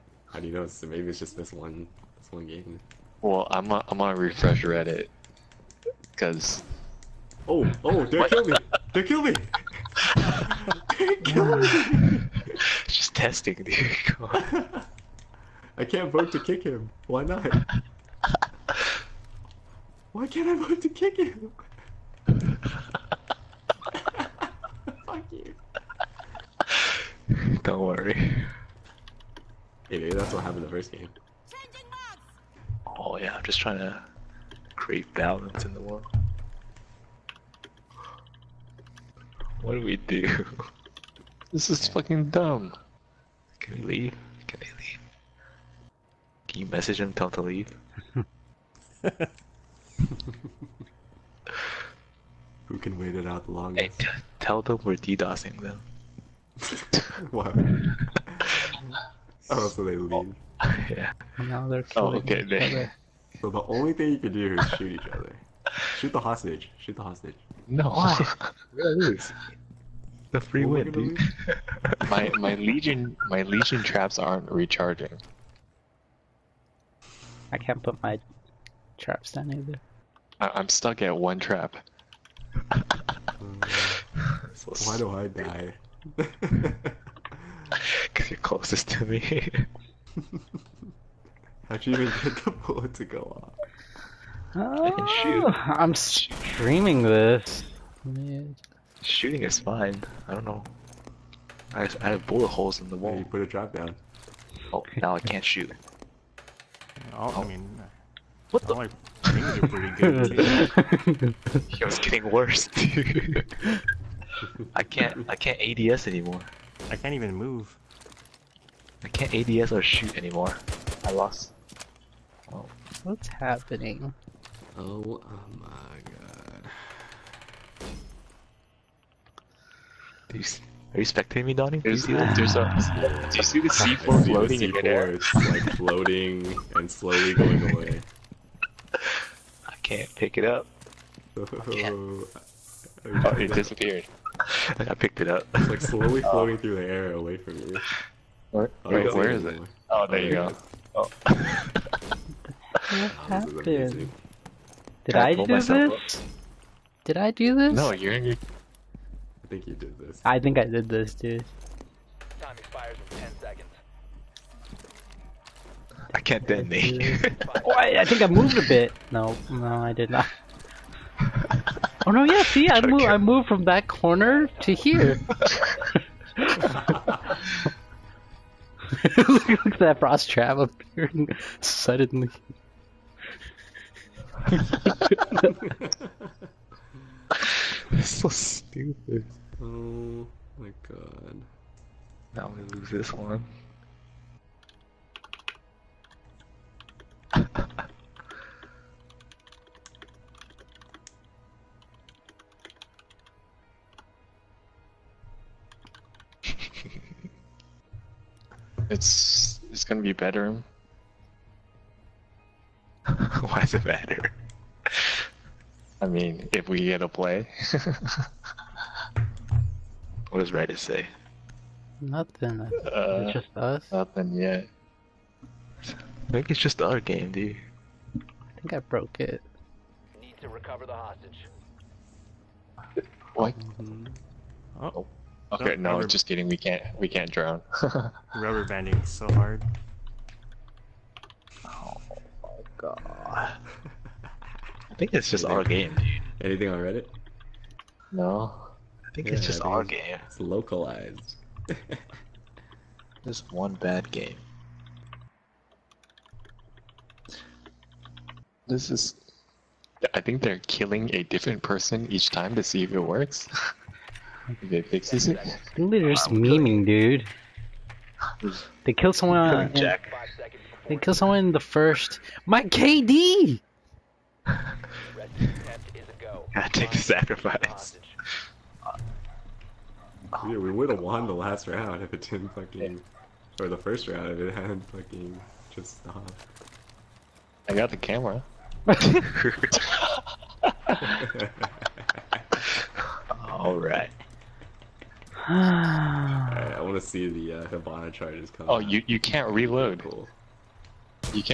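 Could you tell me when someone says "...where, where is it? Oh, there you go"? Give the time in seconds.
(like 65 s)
148 s.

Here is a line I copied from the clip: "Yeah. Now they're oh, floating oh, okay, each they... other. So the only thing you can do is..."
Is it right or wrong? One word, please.
wrong.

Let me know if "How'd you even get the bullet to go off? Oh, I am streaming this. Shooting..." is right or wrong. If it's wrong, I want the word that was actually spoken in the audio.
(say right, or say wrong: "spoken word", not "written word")
right.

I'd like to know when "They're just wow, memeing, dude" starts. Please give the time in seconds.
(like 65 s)
265 s.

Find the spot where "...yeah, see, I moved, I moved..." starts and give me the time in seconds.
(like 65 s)
172 s.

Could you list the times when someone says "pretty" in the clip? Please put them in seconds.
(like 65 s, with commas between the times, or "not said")
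109 s.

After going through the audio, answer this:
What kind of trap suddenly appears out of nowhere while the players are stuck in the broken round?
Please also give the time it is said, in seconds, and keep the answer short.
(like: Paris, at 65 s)
frost trap, at 179 s.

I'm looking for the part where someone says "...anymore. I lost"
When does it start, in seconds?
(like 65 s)
120 s.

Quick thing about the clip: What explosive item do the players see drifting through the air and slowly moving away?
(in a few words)
C4.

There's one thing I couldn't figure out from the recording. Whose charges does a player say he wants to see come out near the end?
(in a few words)
Hibana.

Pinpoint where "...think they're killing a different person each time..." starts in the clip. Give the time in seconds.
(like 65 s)
260 s.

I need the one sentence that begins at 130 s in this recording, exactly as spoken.
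Are you, are you spectating me, Donnie?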